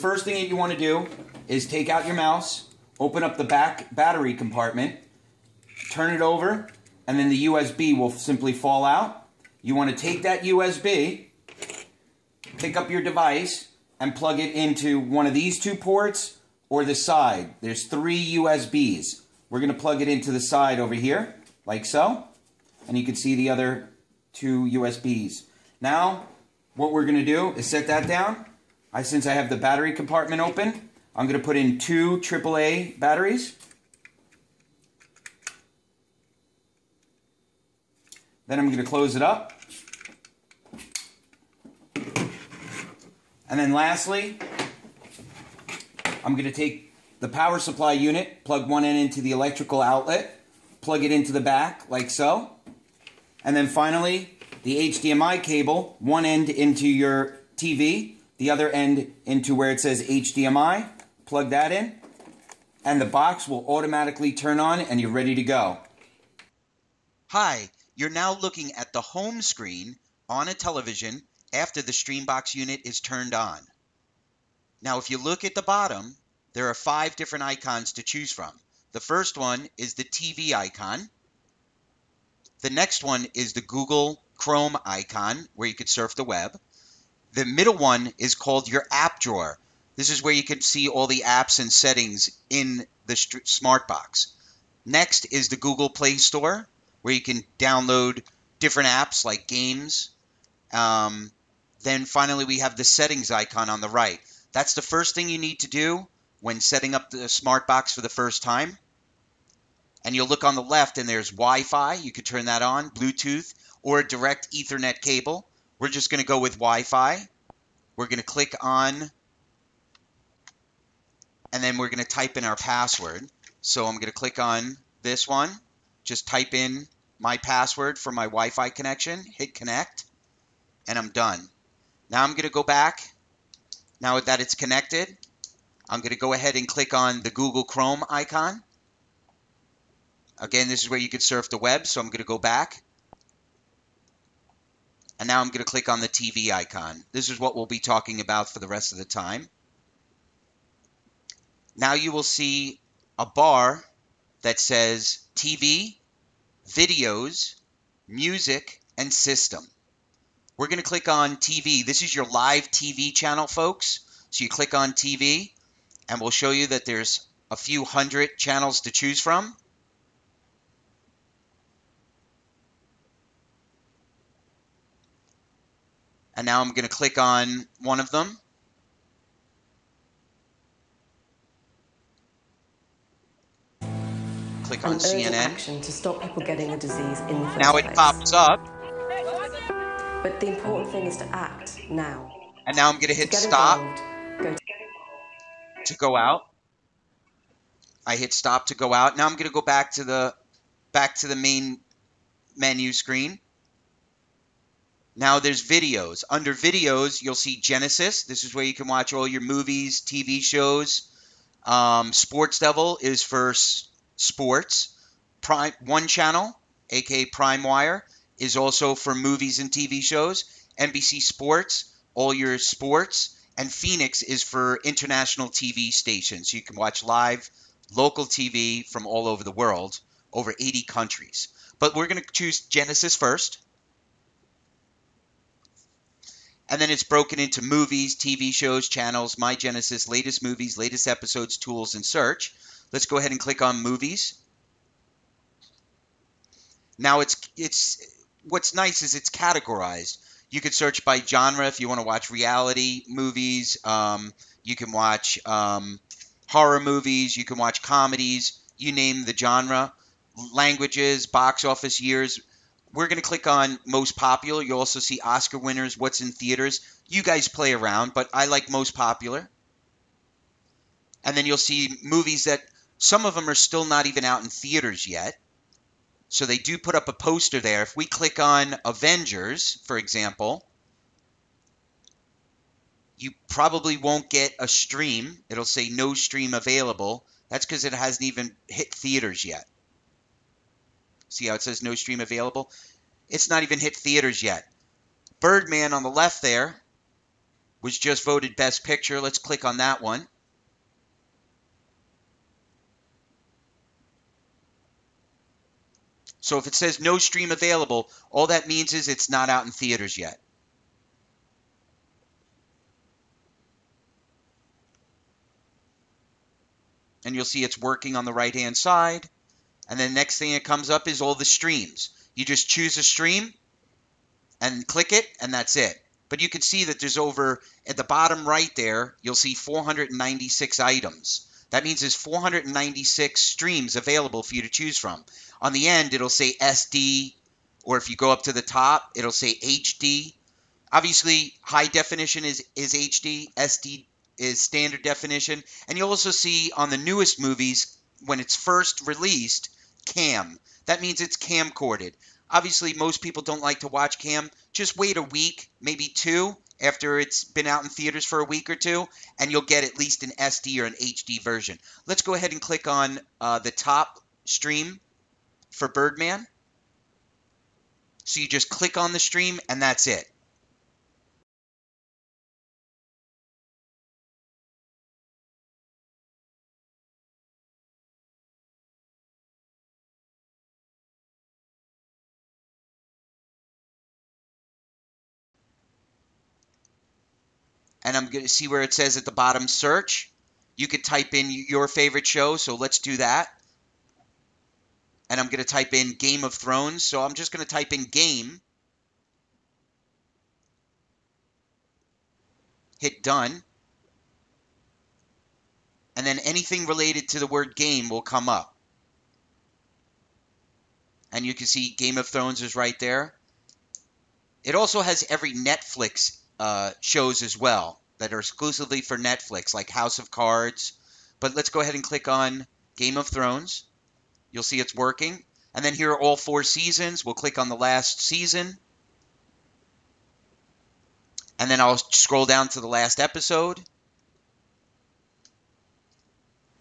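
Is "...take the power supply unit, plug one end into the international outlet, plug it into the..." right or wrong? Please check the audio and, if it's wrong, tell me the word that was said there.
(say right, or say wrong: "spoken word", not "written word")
wrong: "electrical", not "international".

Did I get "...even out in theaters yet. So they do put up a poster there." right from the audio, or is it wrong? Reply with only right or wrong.
right.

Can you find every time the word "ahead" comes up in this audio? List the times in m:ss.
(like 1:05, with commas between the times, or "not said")
2:16, 4:03, 6:02, 7:01.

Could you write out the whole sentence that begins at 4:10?
You could search by genre if you want to watch reality movies.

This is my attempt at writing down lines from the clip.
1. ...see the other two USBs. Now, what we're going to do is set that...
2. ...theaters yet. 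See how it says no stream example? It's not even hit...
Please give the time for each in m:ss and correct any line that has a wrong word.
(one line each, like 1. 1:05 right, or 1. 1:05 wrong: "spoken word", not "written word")
1. 0:23 right
2. 4:48 wrong: "available", not "example".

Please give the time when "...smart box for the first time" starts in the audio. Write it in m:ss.
1:47.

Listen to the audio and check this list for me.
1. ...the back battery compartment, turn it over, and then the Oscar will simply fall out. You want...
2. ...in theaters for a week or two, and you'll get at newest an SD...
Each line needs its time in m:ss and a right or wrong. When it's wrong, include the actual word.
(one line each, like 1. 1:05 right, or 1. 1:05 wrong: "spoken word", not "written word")
1. 0:03 wrong: "USB", not "Oscar"
2. 5:57 wrong: "least", not "newest".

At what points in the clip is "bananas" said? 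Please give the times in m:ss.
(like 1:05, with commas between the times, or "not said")
not said.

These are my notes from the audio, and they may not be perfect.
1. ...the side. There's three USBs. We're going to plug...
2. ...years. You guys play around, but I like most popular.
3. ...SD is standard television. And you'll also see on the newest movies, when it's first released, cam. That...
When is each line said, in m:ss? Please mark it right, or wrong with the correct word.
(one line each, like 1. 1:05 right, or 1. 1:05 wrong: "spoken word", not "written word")
1. 0:16 right
2. 4:26 wrong: "theaters", not "years"
3. 5:43 wrong: "definition", not "television".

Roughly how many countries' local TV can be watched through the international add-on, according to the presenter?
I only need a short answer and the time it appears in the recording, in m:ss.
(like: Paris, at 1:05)
over 80, at 3:50.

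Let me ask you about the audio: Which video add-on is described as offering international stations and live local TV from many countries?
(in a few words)
Phoenix.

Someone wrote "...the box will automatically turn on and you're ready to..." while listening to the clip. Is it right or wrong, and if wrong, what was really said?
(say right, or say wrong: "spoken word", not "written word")
right.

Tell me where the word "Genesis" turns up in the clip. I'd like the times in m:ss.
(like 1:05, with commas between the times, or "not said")
3:27, 3:52, 3:59.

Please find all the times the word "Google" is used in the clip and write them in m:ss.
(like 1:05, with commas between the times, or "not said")
1:23, 1:35, 2:17.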